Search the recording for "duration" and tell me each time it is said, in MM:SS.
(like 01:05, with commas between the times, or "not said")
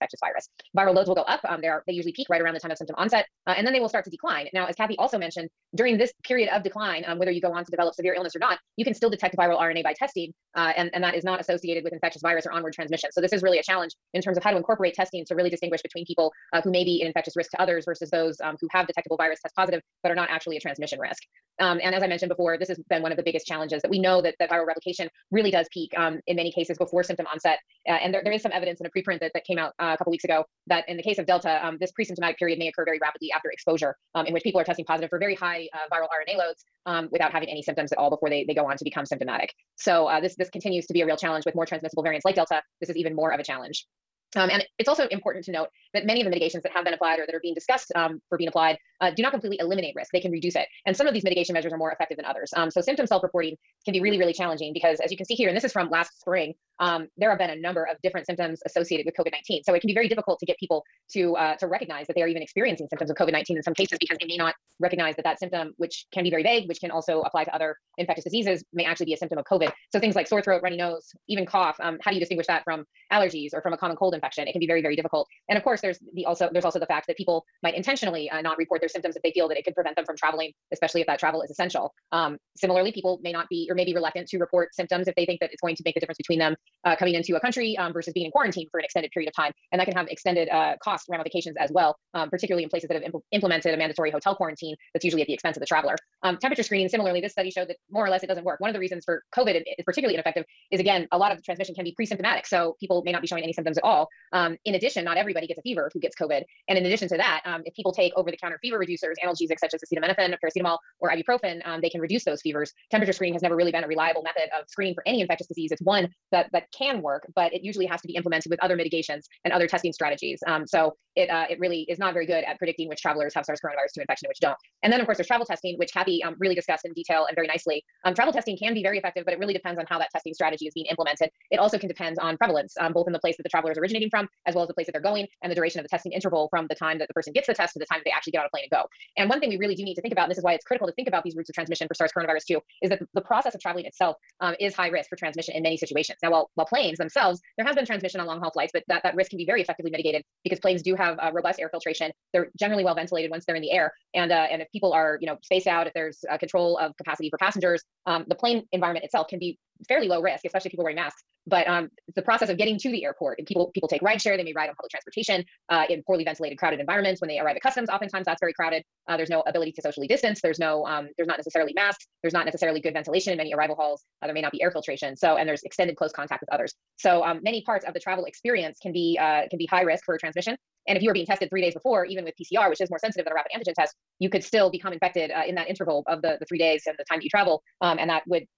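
02:15.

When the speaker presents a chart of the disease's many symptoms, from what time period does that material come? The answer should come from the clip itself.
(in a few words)
last spring.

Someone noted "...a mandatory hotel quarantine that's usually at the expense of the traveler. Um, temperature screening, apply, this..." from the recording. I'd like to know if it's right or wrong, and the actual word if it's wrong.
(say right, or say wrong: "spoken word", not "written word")
wrong: "similarly", not "apply".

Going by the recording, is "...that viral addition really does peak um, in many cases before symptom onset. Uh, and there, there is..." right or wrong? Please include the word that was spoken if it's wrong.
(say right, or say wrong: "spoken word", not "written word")
wrong: "replication", not "addition".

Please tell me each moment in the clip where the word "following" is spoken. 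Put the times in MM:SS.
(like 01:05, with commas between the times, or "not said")
not said.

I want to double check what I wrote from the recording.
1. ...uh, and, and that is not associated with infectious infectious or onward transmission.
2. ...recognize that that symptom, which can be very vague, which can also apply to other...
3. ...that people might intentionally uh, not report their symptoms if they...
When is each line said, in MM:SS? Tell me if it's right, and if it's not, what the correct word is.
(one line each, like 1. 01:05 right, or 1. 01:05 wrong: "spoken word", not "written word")
1. 00:10 wrong: "virus", not "infectious"
2. 01:04 right
3. 01:17 right.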